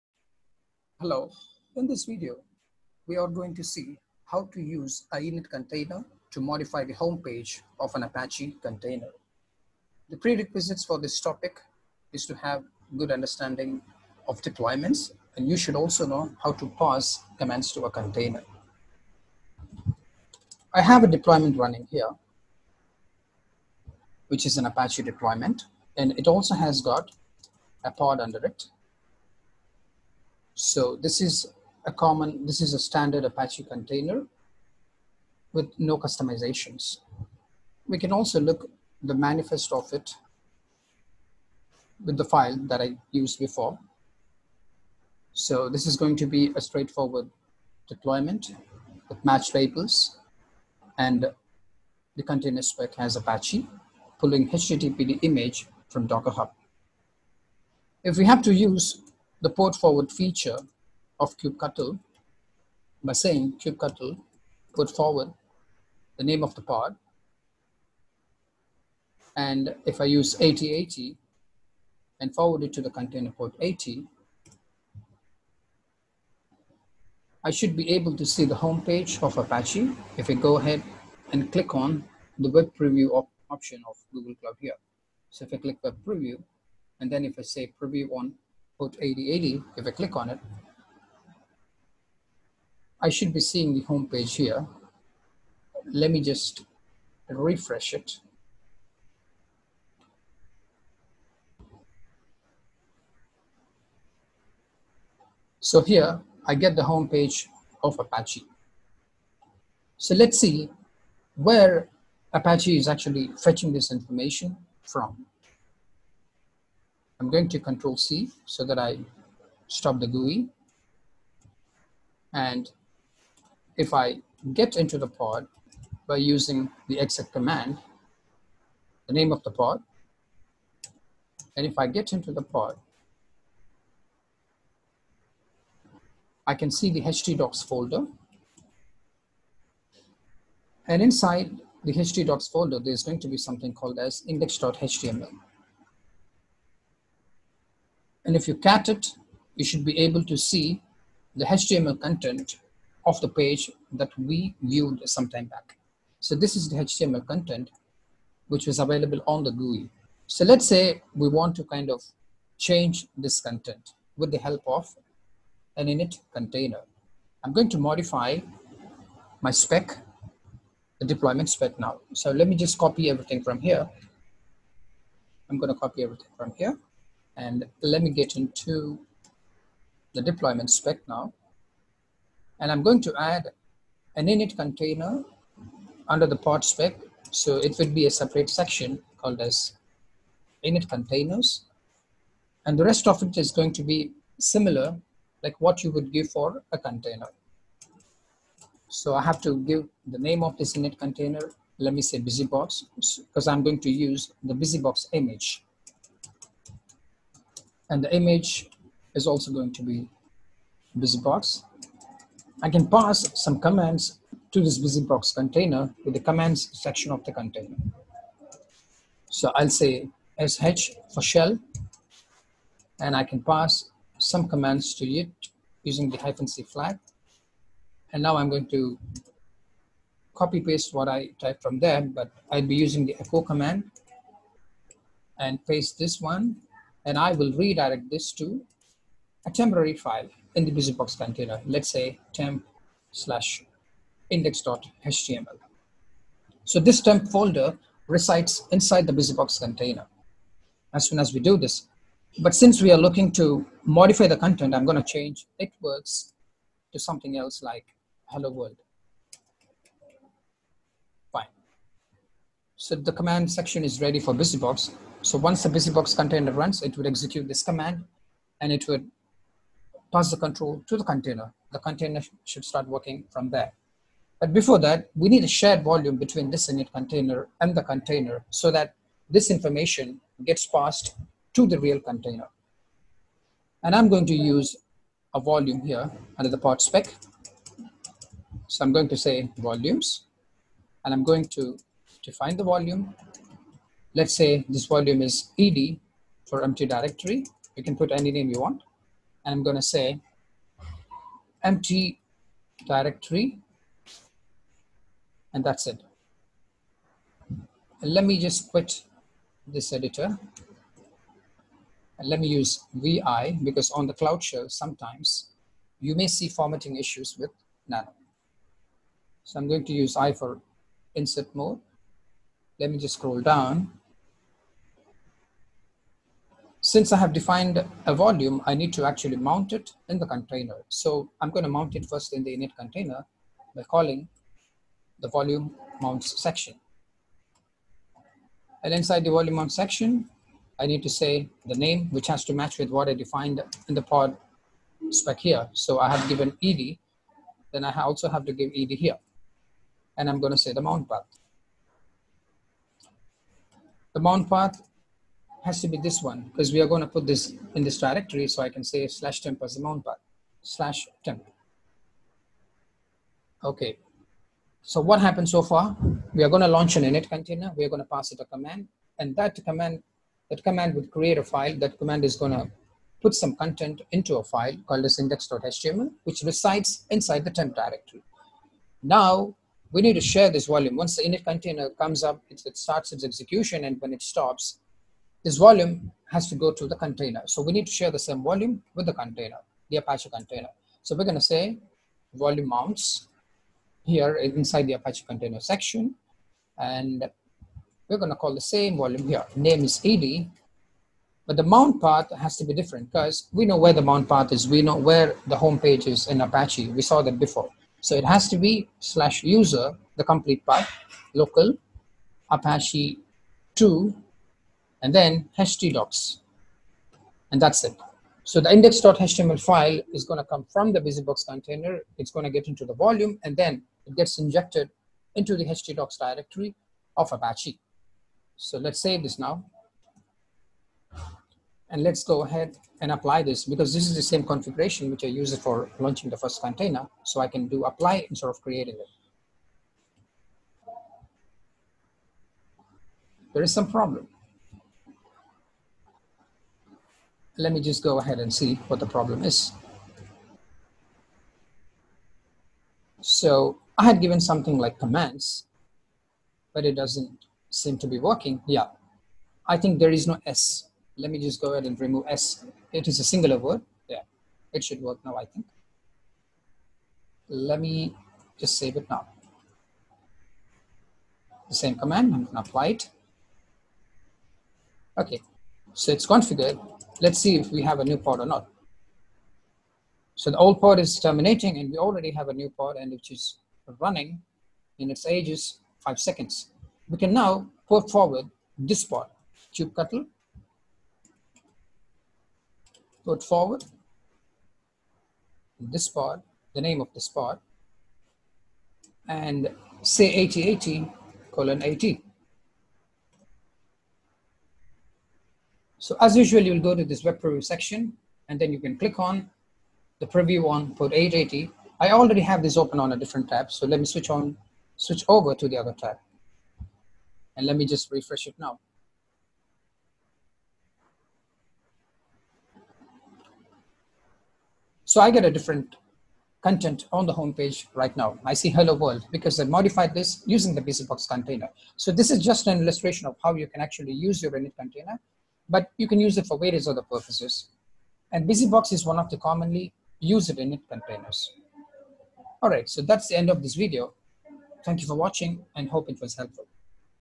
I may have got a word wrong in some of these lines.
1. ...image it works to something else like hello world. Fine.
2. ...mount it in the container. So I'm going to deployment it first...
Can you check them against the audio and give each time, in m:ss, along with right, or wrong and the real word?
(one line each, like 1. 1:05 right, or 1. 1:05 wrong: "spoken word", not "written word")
1. 4:15 wrong: "change", not "image"
2. 5:29 wrong: "mount", not "deployment".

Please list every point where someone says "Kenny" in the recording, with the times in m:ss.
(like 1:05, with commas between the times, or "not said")
not said.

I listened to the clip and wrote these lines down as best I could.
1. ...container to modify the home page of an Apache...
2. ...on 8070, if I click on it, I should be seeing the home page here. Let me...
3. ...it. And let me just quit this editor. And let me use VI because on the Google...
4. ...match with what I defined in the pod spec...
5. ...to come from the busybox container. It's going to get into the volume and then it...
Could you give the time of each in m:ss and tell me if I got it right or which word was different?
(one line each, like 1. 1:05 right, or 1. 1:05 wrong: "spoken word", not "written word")
1. 0:05 right
2. 1:28 wrong: "8080", not "8070"
3. 5:05 wrong: "Cloud", not "Google"
4. 5:42 right
5. 7:00 right.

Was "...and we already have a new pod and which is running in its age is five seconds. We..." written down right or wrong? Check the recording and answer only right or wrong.
right.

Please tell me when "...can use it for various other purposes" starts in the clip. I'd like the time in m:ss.
8:56.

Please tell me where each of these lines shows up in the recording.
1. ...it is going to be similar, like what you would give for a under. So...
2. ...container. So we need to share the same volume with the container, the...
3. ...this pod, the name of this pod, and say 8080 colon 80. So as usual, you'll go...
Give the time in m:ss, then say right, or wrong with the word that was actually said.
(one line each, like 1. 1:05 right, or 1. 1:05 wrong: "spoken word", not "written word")
1. 3:13 wrong: "container", not "under"
2. 6:26 right
3. 8:15 right.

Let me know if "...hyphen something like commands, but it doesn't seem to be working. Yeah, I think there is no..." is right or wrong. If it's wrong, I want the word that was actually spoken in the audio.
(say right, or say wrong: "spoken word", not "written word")
wrong: "given", not "hyphen".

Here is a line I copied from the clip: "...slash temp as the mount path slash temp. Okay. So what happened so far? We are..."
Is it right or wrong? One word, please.
right.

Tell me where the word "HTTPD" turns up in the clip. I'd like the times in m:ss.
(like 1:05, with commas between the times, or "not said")
0:54.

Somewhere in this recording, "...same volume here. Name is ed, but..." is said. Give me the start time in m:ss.
6:38.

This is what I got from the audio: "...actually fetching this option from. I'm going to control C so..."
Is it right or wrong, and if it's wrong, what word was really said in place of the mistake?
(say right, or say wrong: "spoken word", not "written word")
wrong: "information", not "option".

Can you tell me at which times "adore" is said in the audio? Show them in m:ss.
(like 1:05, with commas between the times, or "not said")
not said.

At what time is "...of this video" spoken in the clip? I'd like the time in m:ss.
9:03.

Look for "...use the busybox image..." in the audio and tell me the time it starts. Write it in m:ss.
3:23.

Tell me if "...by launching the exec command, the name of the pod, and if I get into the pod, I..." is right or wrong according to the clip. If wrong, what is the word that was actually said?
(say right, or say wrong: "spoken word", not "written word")
wrong: "using", not "launching".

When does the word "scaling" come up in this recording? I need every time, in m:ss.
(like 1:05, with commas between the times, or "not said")
not said.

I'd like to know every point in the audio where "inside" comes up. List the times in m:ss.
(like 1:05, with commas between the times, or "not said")
2:21, 4:08, 5:38, 6:17, 6:34.